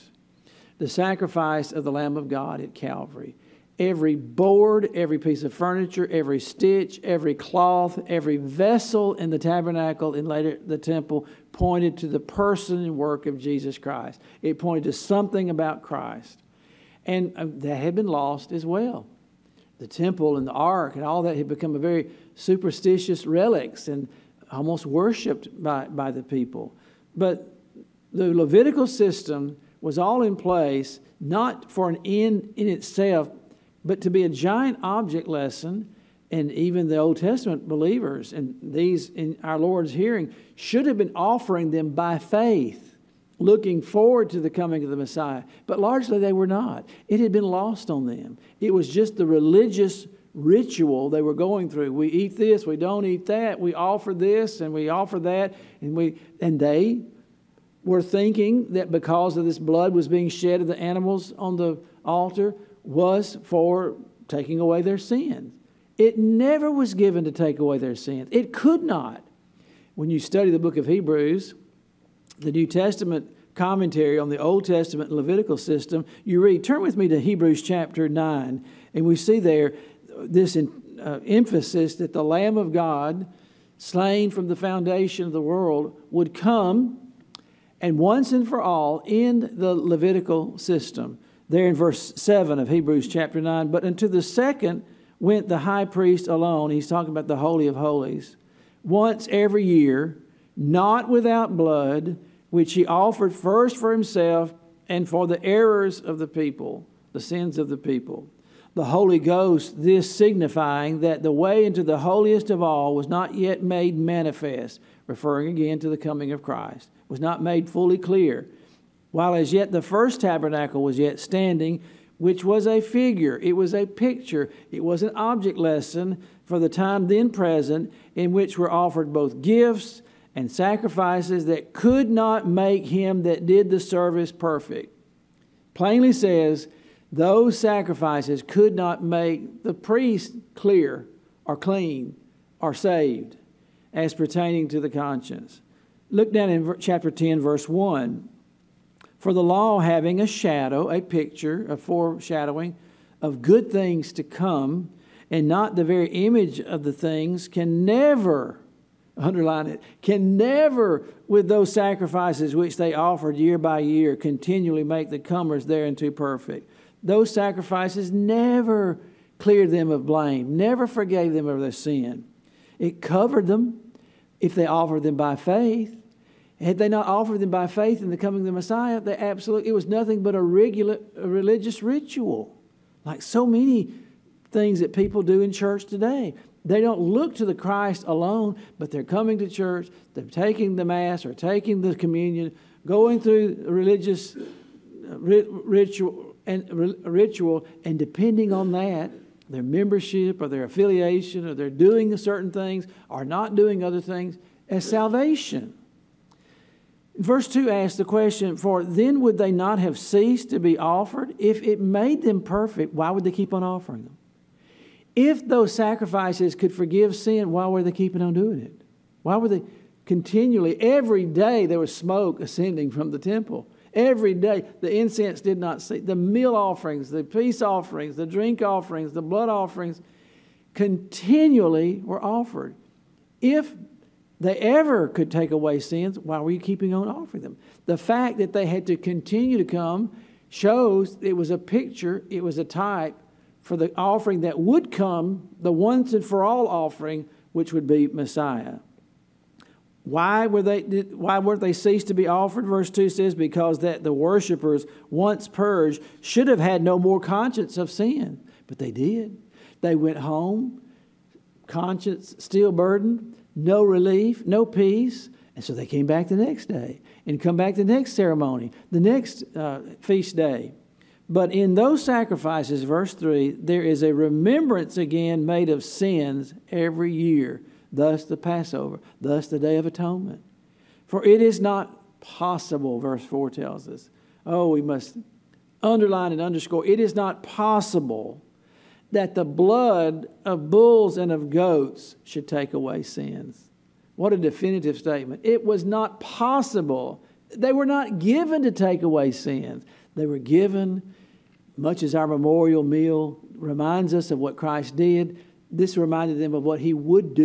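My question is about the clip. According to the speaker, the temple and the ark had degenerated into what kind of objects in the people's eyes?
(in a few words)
Superstitious relics.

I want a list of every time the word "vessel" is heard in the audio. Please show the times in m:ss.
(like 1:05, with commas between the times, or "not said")
0:08.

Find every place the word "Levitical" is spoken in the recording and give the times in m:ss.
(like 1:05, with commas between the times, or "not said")
0:28, 1:15, 1:29.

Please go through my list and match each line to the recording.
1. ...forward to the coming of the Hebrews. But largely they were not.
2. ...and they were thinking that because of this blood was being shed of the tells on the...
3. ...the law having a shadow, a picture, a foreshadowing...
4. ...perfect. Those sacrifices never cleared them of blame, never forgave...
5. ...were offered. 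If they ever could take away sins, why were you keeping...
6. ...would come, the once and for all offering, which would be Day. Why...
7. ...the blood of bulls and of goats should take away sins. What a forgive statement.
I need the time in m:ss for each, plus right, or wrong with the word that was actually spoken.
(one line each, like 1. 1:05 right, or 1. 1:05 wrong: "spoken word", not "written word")
1. 0:43 wrong: "Messiah", not "Hebrews"
2. 0:56 wrong: "animals", not "tells"
3. 2:29 right
4. 2:46 right
5. 3:52 right
6. 4:04 wrong: "Messiah", not "Day"
7. 4:49 wrong: "definitive", not "forgive".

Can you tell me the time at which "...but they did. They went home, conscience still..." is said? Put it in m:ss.
4:18.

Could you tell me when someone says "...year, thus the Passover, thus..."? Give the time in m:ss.
4:37.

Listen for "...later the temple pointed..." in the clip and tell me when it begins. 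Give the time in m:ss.
0:10.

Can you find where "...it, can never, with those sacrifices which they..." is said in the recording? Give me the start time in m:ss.
2:39.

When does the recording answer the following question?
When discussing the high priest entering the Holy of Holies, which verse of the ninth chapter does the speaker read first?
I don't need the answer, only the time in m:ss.
1:31.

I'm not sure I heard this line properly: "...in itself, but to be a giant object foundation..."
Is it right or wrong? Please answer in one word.
wrong.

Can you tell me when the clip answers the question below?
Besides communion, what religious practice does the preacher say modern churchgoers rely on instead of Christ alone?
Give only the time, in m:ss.
3:10.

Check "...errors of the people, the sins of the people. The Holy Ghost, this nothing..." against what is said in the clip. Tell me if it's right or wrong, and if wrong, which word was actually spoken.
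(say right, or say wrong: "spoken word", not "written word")
wrong: "signifying", not "nothing".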